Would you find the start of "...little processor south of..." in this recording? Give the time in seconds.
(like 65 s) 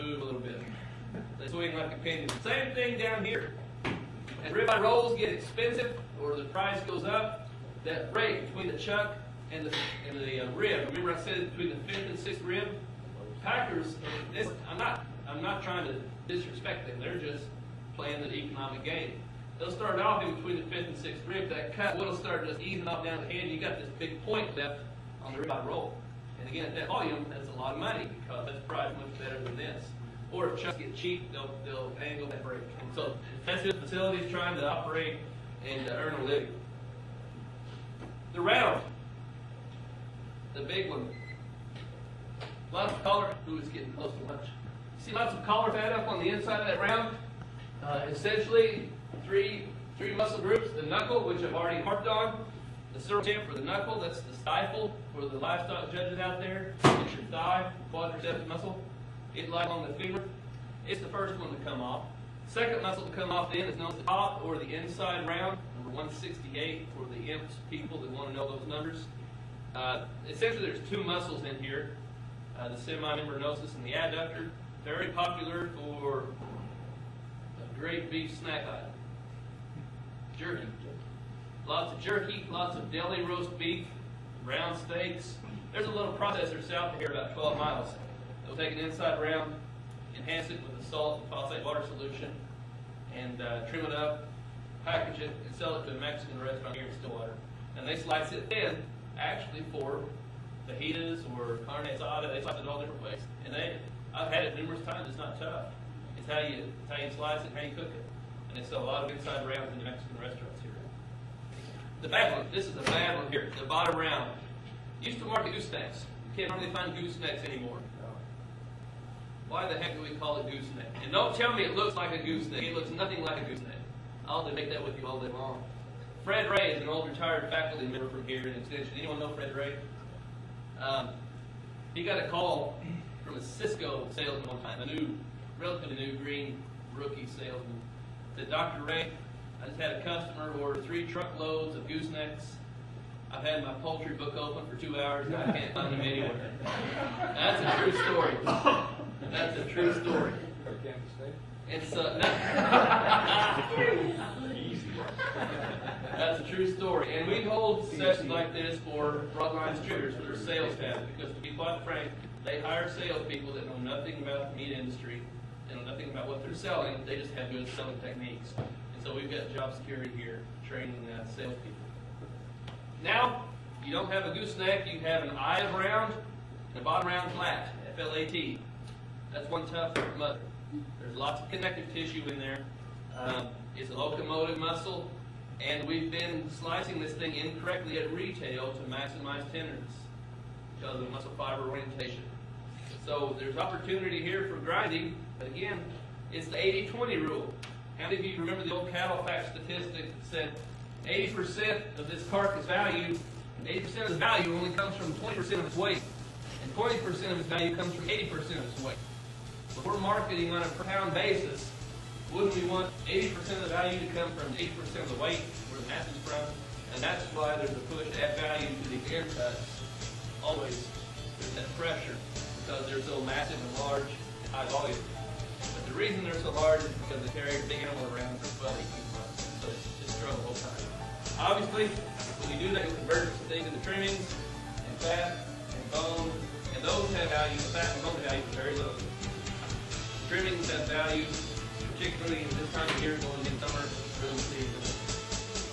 85 s.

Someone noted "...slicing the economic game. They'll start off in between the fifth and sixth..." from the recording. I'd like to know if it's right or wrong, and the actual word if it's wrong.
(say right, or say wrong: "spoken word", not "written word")
wrong: "playing", not "slicing".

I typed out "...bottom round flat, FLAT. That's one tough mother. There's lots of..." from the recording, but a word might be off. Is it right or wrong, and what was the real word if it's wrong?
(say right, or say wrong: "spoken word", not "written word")
right.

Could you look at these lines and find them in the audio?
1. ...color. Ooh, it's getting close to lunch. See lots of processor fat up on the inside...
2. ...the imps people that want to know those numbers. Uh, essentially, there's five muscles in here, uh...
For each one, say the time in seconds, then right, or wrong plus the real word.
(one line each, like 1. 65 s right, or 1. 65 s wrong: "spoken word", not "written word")
1. 43 s wrong: "color", not "processor"
2. 67 s wrong: "two", not "five".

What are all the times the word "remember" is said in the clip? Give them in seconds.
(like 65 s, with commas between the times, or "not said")
10 s, 198 s.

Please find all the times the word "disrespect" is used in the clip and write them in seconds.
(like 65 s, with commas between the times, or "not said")
16 s.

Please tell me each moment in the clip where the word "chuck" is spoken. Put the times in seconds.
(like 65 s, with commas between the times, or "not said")
8 s, 30 s.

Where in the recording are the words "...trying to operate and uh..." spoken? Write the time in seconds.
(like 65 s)
34 s.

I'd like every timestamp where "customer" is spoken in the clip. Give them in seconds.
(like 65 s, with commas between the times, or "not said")
140 s.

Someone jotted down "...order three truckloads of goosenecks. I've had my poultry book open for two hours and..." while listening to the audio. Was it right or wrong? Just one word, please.
right.